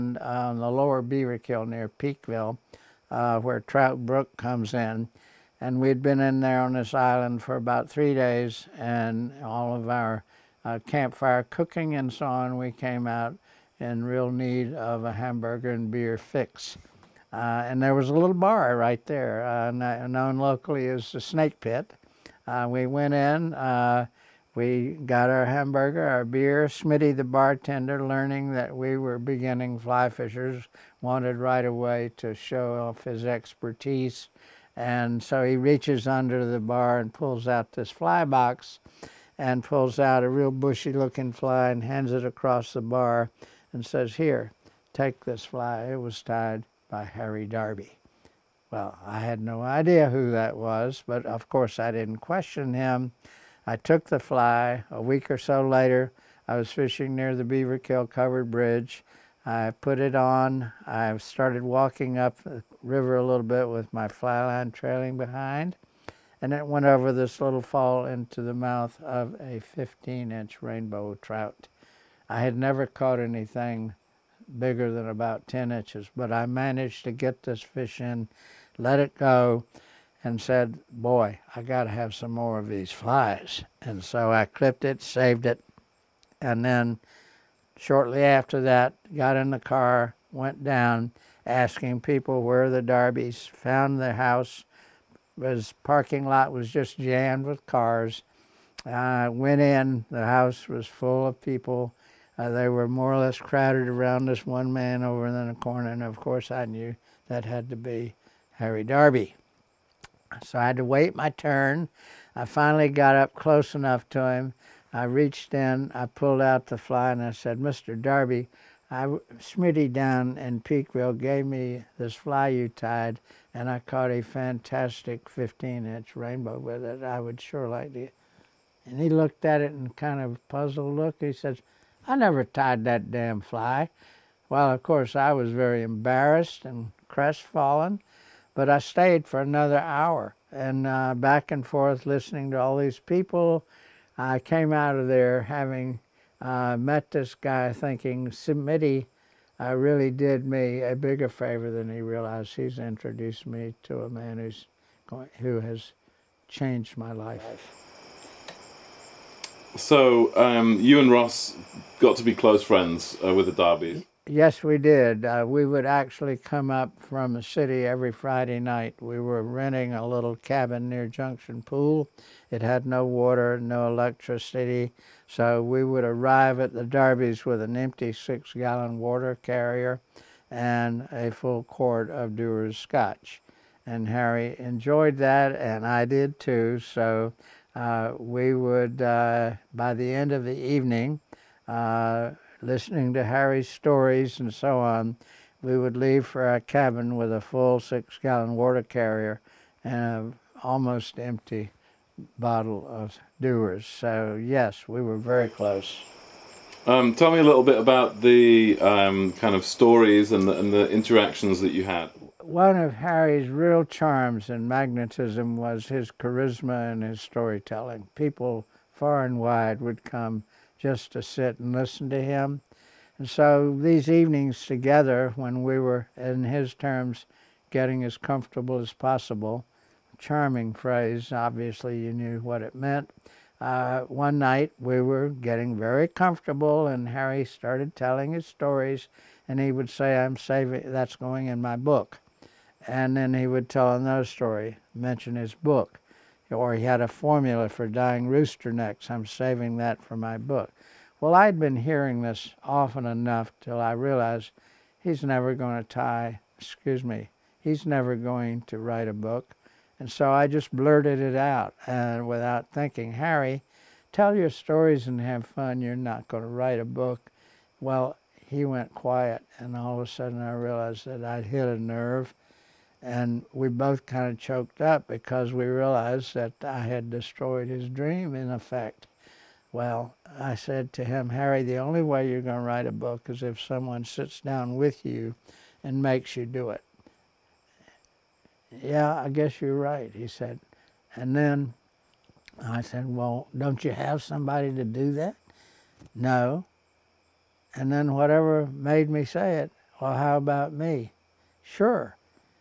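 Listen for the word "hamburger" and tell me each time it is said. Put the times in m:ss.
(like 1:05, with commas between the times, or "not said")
0:15, 0:25.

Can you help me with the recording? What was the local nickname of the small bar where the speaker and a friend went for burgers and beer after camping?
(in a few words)
The Snake Pit.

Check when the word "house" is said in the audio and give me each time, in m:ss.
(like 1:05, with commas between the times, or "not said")
1:34, 1:40.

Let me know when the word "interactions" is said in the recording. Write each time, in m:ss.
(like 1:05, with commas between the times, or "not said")
3:30.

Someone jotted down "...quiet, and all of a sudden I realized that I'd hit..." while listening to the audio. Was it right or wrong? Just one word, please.
right.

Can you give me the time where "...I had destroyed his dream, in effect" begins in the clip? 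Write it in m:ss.
4:36.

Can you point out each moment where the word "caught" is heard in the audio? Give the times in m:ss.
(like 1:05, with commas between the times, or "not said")
1:12, 2:03.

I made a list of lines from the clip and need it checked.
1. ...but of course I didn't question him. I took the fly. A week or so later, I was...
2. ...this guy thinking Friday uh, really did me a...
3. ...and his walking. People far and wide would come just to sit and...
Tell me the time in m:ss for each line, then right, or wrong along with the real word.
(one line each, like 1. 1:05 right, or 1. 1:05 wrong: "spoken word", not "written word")
1. 0:51 right
2. 2:27 wrong: "Smitty", not "Friday"
3. 3:36 wrong: "storytelling", not "walking".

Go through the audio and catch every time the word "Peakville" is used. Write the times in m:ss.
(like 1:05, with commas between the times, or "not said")
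0:01, 2:00.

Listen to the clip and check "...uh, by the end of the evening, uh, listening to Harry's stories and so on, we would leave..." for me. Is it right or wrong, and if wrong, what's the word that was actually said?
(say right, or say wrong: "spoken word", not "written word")
right.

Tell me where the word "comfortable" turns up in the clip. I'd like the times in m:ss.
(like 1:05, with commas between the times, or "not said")
3:48, 3:56.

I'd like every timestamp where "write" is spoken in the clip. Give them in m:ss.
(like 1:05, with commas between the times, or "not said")
4:18, 4:26, 4:42.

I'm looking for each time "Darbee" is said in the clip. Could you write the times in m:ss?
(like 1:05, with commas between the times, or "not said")
0:47, 1:32, 1:48, 1:57, 2:43, 2:56.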